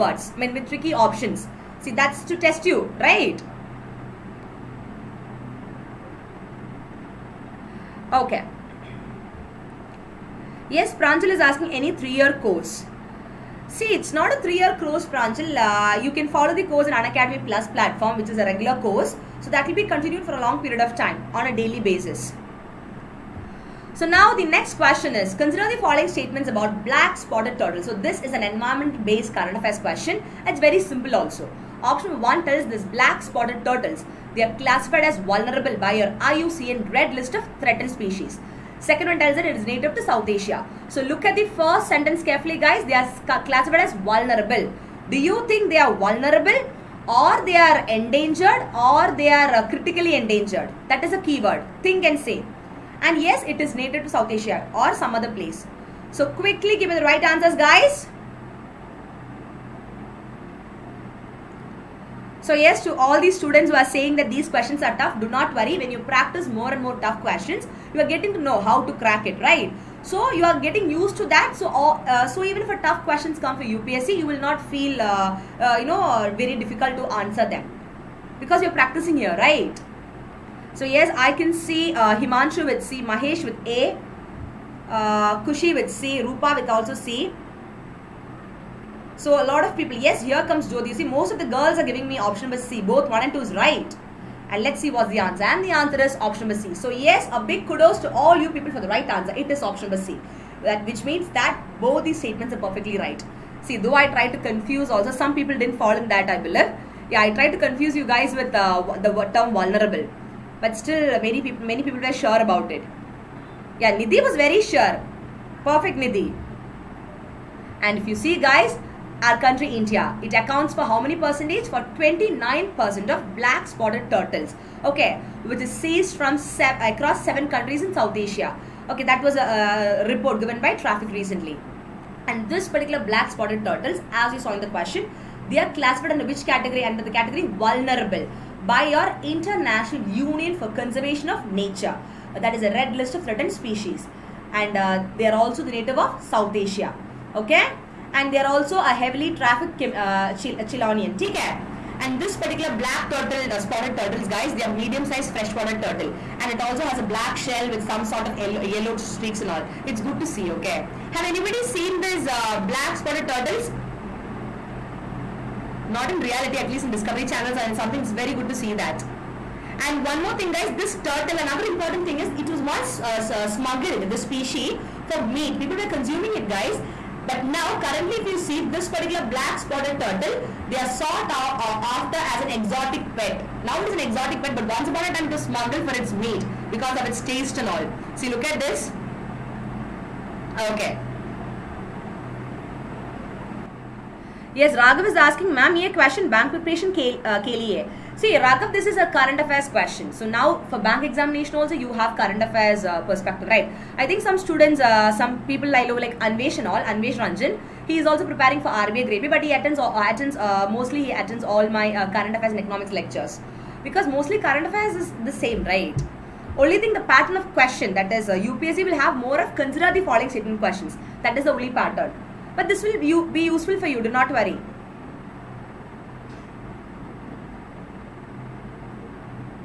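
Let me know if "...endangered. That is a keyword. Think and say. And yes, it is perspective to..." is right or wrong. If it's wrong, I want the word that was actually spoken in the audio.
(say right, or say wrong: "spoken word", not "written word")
wrong: "native", not "perspective".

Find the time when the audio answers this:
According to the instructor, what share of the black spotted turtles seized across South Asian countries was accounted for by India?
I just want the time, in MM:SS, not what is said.
02:01.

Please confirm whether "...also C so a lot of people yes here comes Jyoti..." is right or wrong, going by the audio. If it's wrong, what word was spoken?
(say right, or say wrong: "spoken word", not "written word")
right.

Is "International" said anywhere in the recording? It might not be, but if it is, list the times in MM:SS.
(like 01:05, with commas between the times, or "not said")
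02:19.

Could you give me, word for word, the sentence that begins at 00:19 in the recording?
So that will be continued for a long period of time on a daily basis.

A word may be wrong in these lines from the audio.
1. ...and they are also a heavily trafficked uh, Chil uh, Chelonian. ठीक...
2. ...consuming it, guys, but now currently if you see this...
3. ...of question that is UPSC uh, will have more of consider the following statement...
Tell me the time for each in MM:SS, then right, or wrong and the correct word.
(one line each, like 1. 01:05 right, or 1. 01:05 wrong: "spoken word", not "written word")
1. 02:28 right
2. 02:55 right
3. 03:37 right.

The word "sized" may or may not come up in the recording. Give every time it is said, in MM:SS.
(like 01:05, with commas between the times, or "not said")
02:34.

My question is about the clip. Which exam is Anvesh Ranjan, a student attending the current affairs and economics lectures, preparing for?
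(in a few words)
RBI Grade B.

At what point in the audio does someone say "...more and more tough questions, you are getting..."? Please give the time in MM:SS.
01:06.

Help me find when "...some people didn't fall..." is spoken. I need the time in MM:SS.
01:45.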